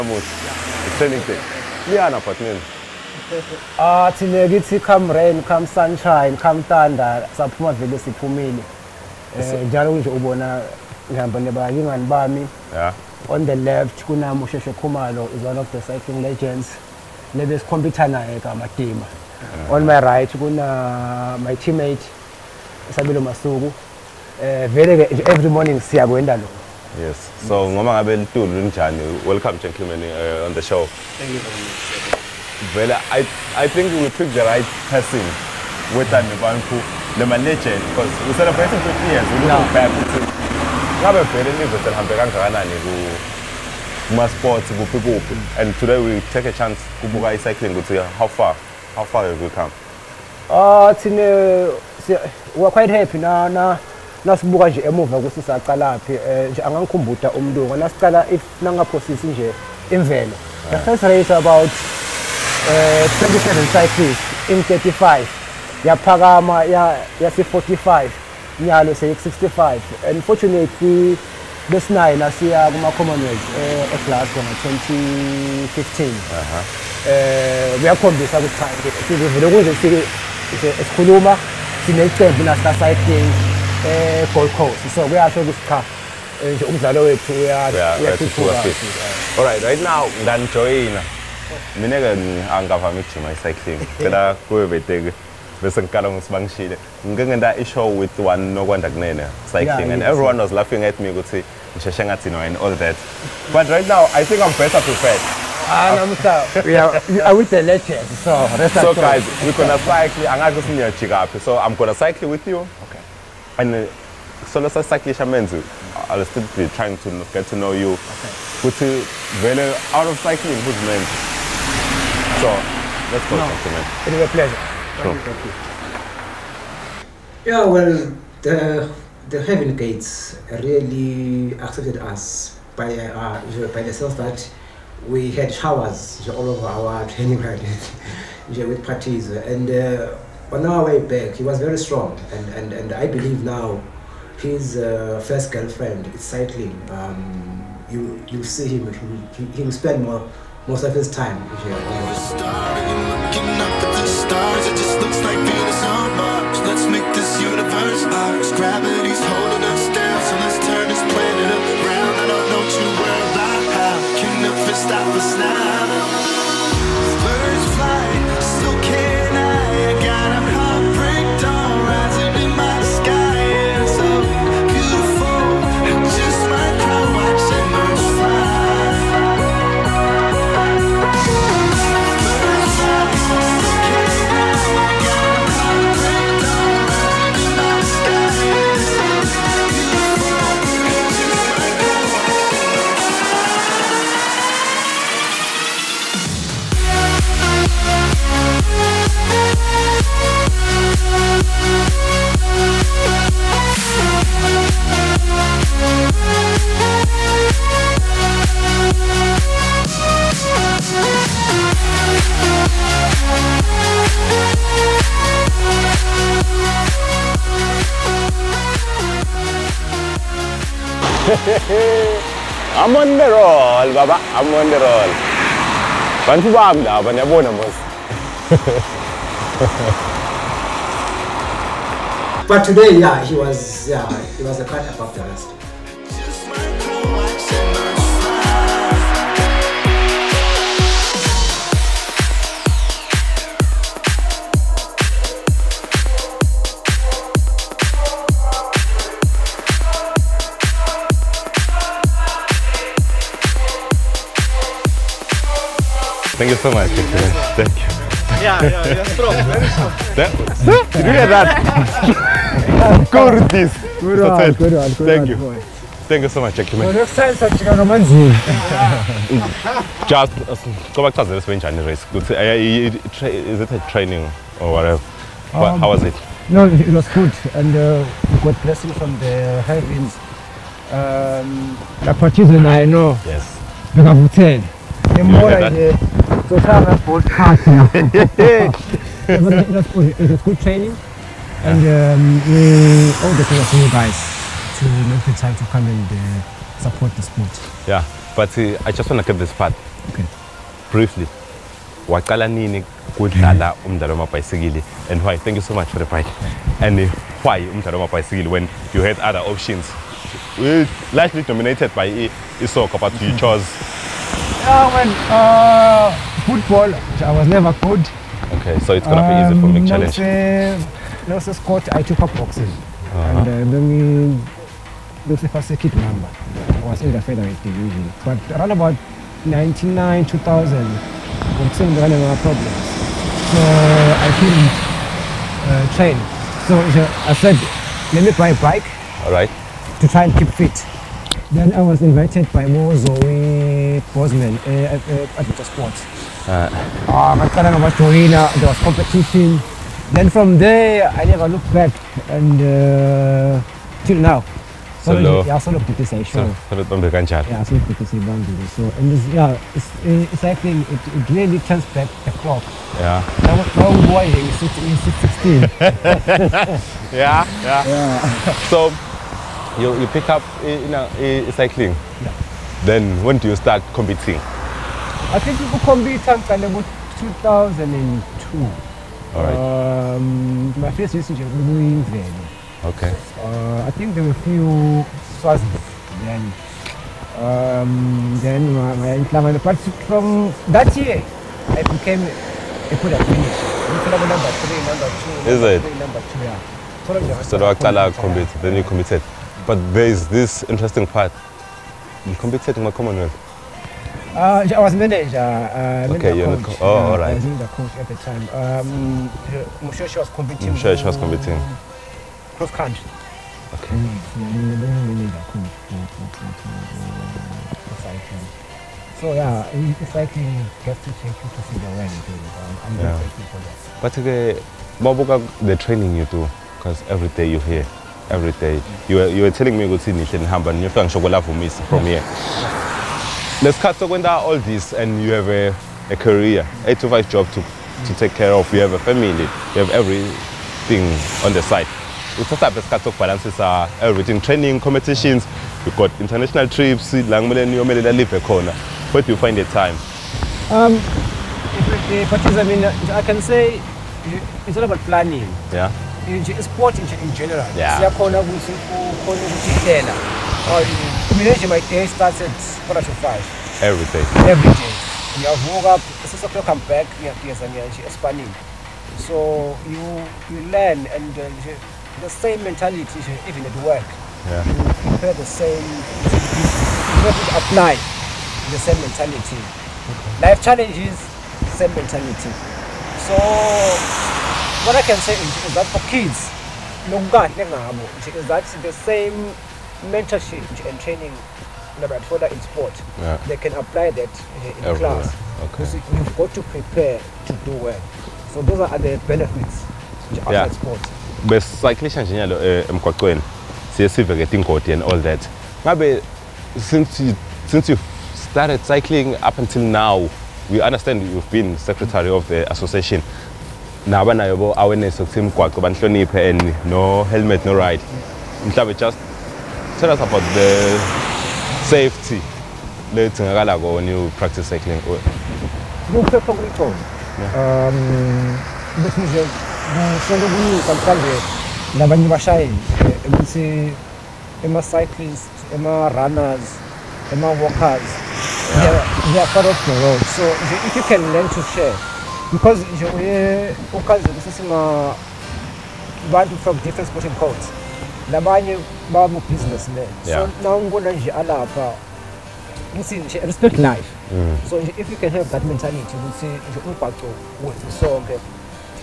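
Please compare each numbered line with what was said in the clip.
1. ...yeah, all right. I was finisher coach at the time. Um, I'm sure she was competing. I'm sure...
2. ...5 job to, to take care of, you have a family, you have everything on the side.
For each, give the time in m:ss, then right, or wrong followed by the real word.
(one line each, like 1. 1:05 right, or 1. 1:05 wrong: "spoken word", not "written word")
1. 6:46 wrong: "manager", not "finisher"
2. 7:17 right.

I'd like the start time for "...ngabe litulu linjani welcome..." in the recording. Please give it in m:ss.
0:27.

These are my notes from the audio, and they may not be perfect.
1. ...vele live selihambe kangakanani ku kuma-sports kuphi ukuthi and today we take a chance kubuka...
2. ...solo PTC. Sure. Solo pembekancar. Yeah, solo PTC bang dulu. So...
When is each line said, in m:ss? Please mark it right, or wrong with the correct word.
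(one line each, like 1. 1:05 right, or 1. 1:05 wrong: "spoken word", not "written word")
1. 0:41 wrong: "kuphi", not "ukuthi"
2. 5:55 right.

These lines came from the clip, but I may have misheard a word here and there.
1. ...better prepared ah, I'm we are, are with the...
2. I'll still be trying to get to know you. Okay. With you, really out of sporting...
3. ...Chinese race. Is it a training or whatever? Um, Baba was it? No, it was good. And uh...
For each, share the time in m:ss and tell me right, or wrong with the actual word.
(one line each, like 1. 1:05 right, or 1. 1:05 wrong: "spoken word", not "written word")
1. 1:44 right
2. 1:56 wrong: "cycling", not "sporting"
3. 4:31 wrong: "How", not "Baba".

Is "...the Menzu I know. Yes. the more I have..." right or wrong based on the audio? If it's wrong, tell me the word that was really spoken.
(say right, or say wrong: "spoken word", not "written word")
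wrong: "Portuguese", not "Menzu".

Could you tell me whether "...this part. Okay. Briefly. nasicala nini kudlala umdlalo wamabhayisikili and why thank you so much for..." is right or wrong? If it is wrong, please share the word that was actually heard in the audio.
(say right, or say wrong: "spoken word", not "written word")
wrong: "waqala", not "nasicala".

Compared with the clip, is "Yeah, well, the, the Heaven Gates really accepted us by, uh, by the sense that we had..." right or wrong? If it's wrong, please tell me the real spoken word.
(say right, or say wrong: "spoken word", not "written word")
right.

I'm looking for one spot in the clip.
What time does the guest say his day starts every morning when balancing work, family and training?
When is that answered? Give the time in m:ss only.
7:42.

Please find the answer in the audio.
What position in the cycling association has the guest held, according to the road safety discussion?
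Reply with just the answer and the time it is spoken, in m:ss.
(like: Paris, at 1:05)
Secretary, at 8:31.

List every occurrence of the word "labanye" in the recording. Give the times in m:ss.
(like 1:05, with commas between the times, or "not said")
8:51, 9:08.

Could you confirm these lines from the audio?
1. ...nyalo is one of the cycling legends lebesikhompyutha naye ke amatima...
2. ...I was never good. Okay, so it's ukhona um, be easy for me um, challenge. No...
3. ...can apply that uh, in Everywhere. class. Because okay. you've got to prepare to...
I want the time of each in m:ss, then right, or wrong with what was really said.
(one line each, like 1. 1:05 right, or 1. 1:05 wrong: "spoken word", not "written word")
1. 0:14 wrong: "khumalo", not "nyalo"
2. 5:17 wrong: "gonna", not "ukhona"
3. 8:13 right.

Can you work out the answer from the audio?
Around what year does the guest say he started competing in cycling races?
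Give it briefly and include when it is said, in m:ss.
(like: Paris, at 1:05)
2002, at 6:17.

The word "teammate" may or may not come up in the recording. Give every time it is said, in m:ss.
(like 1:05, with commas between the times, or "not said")
0:21.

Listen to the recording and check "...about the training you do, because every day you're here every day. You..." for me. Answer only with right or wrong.
right.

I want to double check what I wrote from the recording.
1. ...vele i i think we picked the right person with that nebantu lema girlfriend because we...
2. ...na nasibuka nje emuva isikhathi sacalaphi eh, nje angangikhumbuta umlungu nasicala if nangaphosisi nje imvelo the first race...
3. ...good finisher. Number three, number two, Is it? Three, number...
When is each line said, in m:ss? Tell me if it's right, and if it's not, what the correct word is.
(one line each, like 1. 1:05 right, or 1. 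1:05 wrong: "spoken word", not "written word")
1. 0:32 wrong: "legend", not "girlfriend"
2. 0:53 wrong: "ukuthi", not "isikhathi"
3. 6:32 right.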